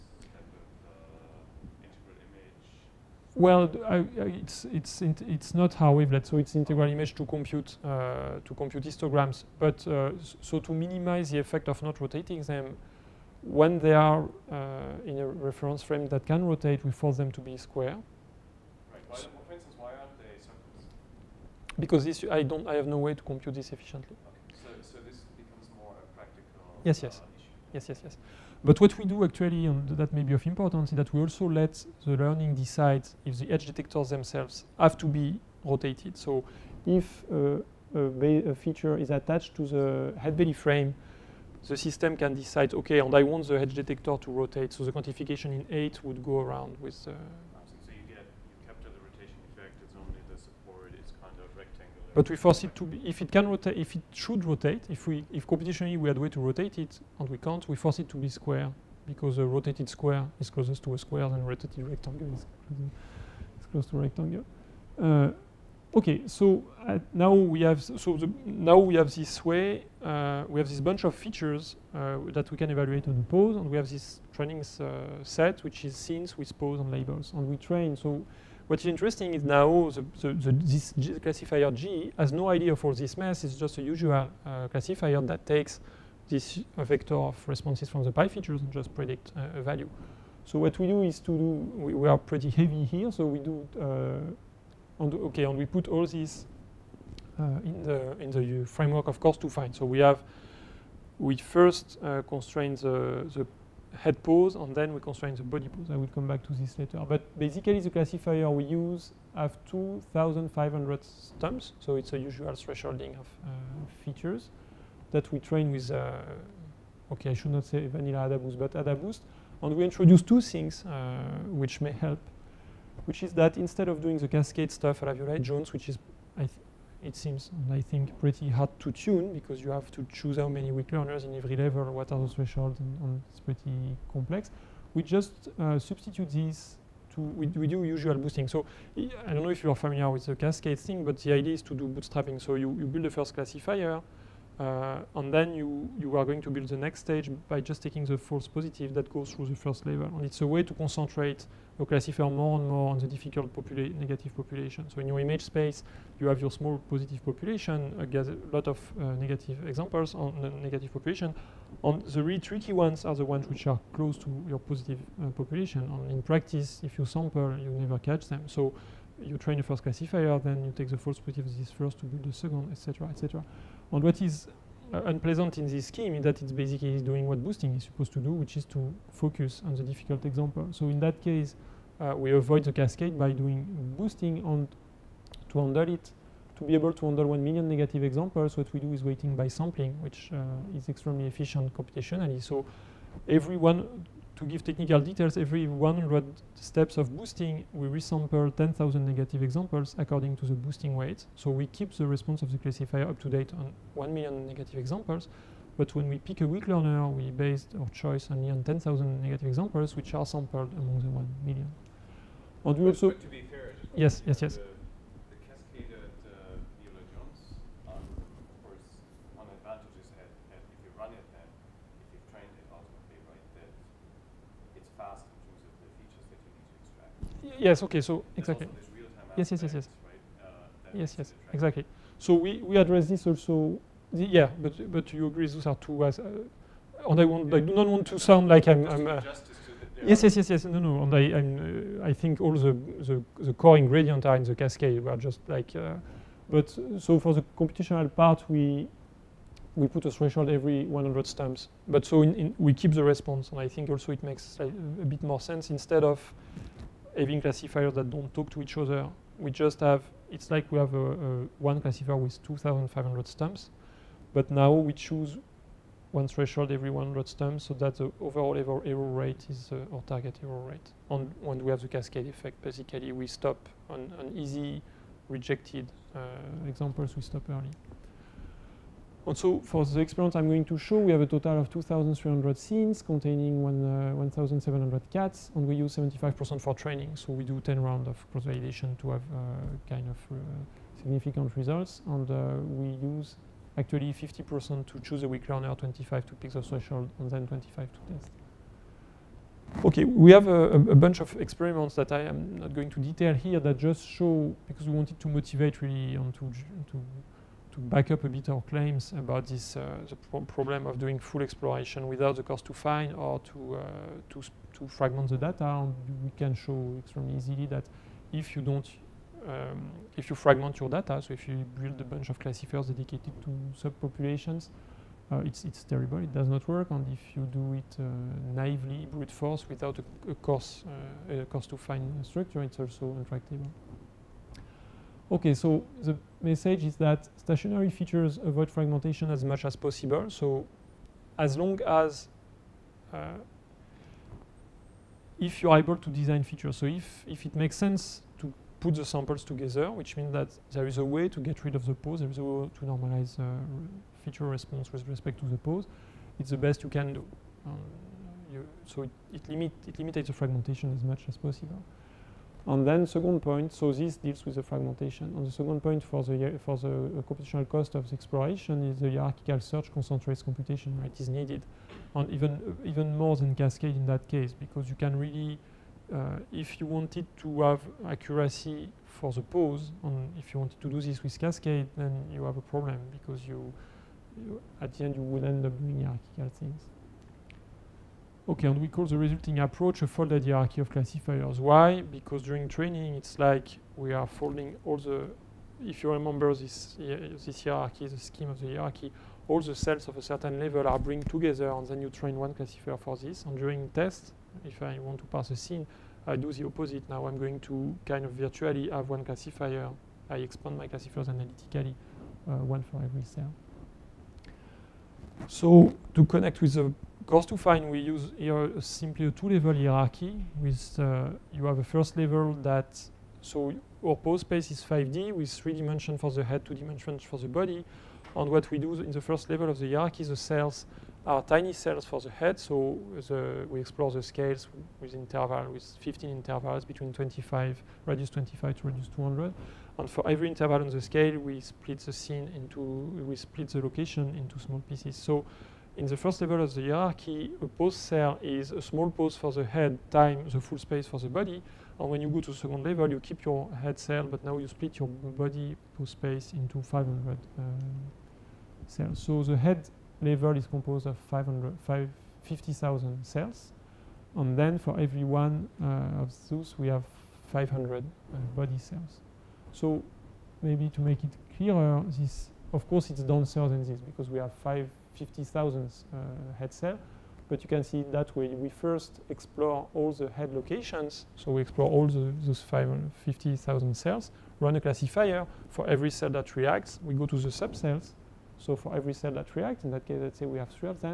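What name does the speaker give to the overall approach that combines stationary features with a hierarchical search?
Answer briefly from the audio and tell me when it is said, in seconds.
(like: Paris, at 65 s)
folded hierarchy of classifiers, at 390 s.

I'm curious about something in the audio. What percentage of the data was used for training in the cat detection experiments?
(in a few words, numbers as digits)
75%.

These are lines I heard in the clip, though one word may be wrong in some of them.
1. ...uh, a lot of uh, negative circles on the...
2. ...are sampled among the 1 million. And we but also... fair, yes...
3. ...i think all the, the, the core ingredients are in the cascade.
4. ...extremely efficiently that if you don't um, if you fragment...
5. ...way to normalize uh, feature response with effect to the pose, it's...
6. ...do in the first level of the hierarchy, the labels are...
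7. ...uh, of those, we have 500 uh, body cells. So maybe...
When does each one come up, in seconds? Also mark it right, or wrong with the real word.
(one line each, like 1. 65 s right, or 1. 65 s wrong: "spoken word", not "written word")
1. 157 s wrong: "examples", not "circles"
2. 210 s right
3. 242 s right
4. 316 s wrong: "easily", not "efficiently"
5. 352 s wrong: "respect", not "effect"
6. 428 s wrong: "cells", not "labels"
7. 465 s right.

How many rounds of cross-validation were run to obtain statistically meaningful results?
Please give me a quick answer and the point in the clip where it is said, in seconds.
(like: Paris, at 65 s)
10, at 287 s.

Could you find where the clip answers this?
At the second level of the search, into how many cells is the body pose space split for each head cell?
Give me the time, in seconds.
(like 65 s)
456 s.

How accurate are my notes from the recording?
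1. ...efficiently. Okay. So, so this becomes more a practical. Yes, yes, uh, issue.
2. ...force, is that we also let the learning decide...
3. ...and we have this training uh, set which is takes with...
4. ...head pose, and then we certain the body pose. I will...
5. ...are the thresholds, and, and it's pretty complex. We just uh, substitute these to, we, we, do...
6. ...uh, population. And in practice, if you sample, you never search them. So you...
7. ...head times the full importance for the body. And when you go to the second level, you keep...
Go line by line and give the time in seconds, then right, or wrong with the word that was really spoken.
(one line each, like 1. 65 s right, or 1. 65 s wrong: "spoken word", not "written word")
1. 23 s right
2. 30 s wrong: "importance", not "force"
3. 73 s wrong: "scenes", not "takes"
4. 103 s wrong: "constrain", not "certain"
5. 132 s right
6. 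165 s wrong: "catch", not "search"
7. 449 s wrong: "space", not "importance".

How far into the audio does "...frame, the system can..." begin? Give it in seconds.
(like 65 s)
40 s.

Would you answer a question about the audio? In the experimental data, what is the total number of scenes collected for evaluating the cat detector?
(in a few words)
2,300.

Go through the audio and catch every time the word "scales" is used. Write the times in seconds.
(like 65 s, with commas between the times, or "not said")
434 s, 440 s.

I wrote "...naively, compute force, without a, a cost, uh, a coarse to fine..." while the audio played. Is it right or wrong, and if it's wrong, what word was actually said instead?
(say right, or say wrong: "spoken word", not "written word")
wrong: "brute", not "compute".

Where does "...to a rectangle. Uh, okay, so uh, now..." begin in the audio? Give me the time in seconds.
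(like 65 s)
63 s.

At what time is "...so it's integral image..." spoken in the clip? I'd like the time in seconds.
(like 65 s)
6 s.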